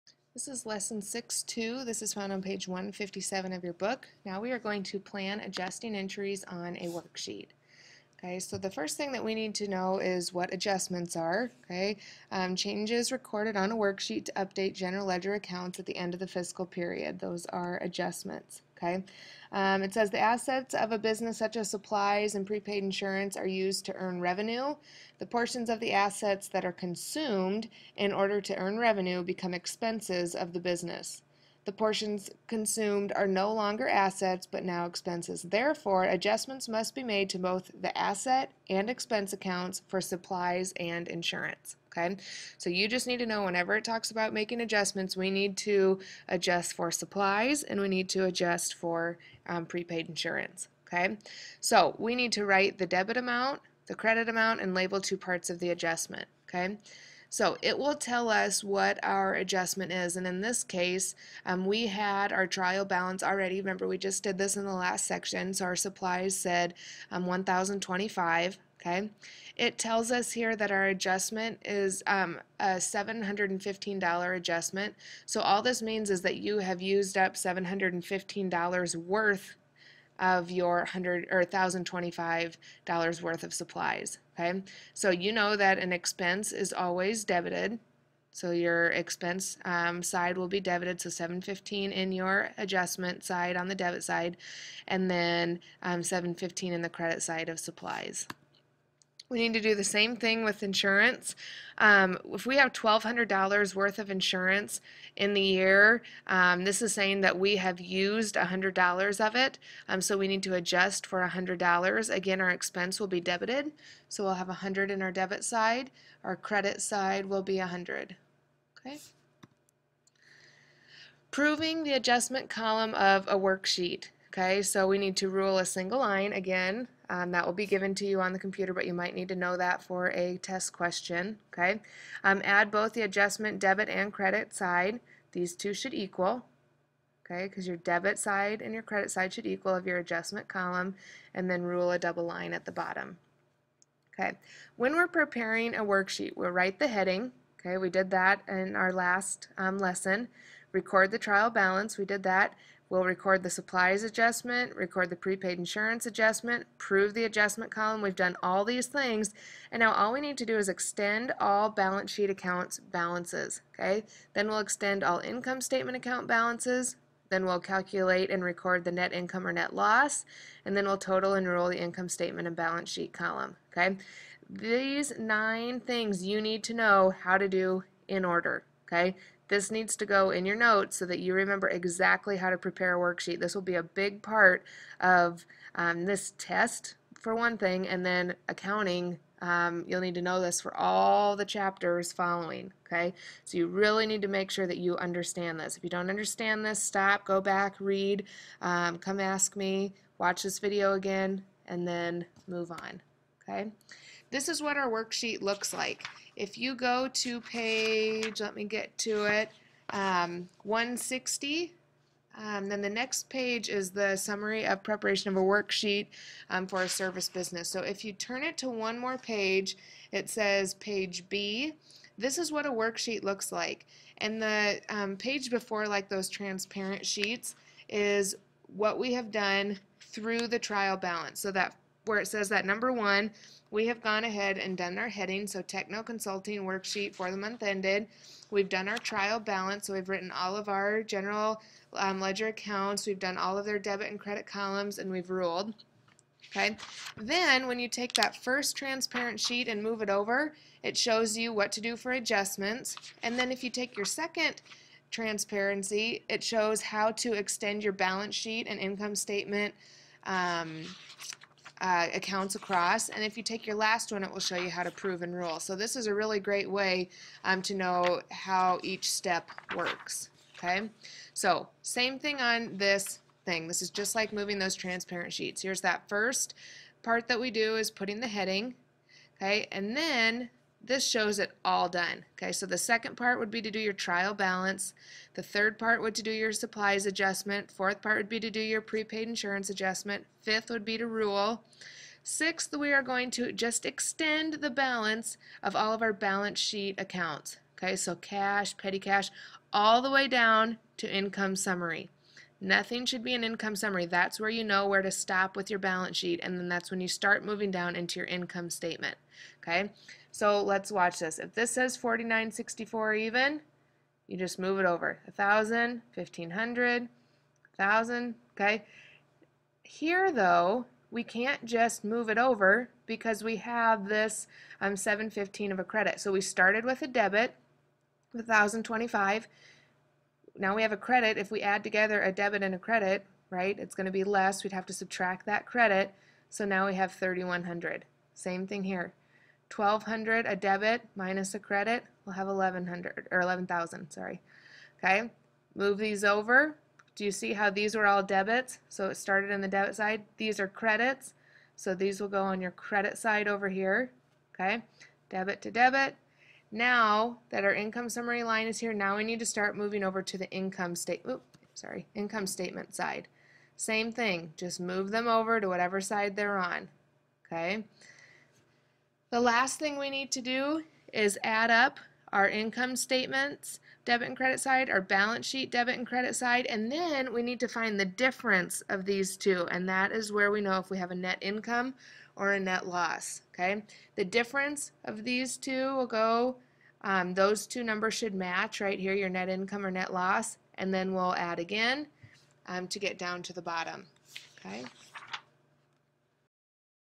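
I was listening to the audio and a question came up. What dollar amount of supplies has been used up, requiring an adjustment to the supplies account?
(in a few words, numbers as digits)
$715.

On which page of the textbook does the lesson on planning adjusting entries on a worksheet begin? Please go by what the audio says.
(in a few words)
157.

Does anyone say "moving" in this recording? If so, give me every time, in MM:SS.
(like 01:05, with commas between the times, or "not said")
04:34, 05:07, 05:59.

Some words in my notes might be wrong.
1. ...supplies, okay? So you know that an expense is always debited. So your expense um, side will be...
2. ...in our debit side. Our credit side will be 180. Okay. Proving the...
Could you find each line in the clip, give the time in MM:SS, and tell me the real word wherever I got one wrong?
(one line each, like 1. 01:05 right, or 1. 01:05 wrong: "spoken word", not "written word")
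1. 01:23 right
2. 01:54 wrong: "100", not "180".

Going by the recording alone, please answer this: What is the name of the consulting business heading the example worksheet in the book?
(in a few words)
TechKnow Consulting.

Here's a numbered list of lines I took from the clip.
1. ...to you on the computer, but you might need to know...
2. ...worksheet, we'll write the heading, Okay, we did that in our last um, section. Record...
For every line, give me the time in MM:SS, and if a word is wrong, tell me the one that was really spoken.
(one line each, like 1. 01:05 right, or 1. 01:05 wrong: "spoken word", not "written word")
1. 02:07 right
2. 02:25 wrong: "lesson", not "section".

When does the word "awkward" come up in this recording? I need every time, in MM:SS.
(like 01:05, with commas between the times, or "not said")
not said.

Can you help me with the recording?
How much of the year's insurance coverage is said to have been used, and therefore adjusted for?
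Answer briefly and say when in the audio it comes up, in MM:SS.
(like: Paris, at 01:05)
$100, at 01:47.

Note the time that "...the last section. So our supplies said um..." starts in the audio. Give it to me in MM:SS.
01:04.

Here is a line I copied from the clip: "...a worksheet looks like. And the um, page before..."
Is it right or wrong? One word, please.
right.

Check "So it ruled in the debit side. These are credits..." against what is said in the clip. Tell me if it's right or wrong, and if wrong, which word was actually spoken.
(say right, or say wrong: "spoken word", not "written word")
wrong: "started", not "ruled".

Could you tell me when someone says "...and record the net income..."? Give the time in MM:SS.
02:48.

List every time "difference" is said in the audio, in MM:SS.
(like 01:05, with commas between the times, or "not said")
06:18, 06:24.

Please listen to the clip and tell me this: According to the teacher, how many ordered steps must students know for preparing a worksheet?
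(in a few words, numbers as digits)
9.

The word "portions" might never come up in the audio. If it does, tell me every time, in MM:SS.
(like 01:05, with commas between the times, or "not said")
00:25, 00:31.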